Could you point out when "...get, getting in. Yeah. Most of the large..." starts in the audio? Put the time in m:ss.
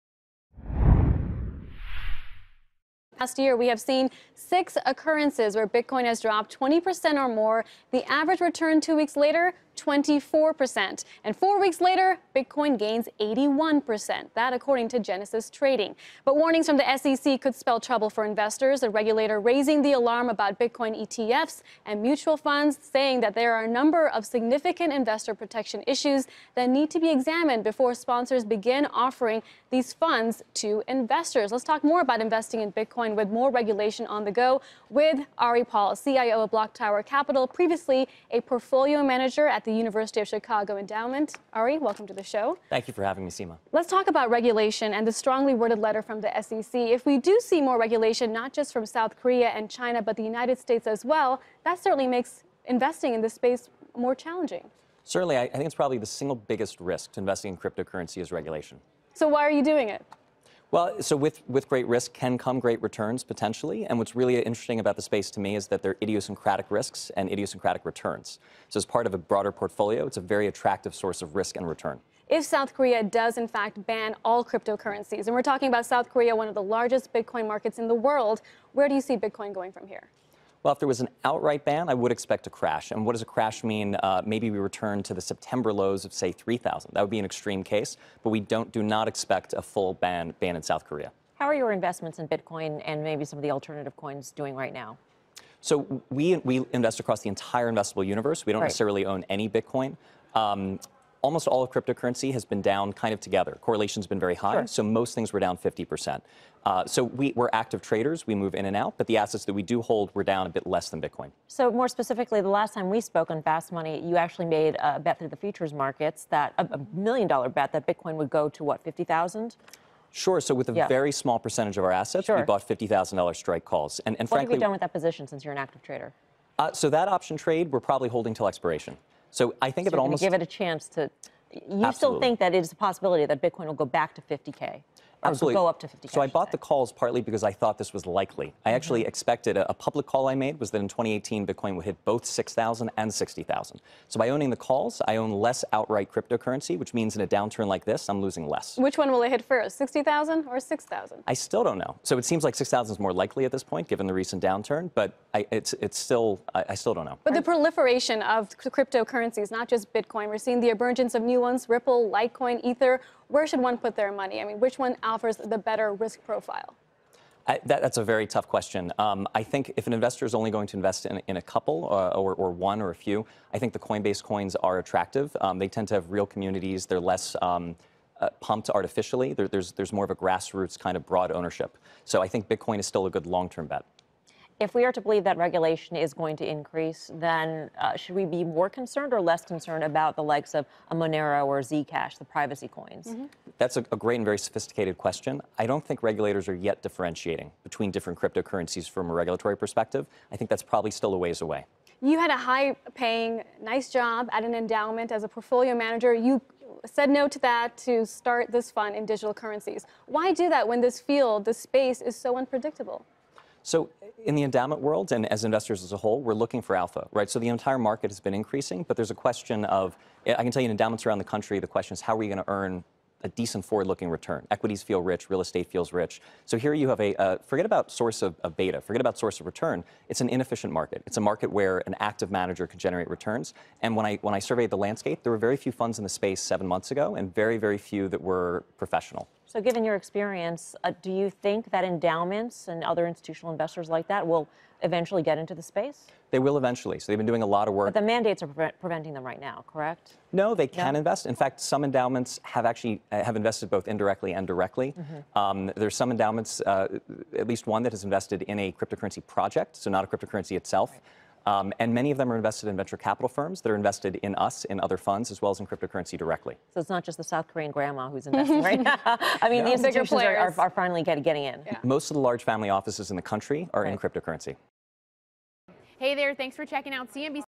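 4:31.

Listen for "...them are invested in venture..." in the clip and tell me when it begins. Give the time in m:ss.
4:22.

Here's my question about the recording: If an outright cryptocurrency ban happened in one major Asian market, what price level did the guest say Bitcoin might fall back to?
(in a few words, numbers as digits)
3,000.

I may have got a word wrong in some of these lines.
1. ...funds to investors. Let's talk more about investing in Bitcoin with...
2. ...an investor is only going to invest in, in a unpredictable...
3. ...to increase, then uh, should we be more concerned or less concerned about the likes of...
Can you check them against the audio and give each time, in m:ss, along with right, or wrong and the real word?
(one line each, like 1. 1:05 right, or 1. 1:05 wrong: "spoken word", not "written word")
1. 0:29 right
2. 2:49 wrong: "couple", not "unpredictable"
3. 3:06 right.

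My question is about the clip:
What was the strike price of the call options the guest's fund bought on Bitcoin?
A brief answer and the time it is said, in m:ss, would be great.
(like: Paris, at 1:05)
$50,000, at 2:02.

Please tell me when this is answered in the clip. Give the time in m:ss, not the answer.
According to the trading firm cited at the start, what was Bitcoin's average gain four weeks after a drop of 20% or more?
0:13.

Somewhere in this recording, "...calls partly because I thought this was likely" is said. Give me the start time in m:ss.
2:16.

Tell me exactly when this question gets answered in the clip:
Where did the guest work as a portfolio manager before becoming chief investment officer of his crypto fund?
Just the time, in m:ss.
0:39.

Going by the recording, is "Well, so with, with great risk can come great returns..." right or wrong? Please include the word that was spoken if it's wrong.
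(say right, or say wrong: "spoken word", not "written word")
right.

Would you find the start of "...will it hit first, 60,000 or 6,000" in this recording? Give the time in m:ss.
2:29.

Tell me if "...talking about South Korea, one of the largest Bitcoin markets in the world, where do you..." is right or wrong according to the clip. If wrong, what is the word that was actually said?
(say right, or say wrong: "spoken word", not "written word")
right.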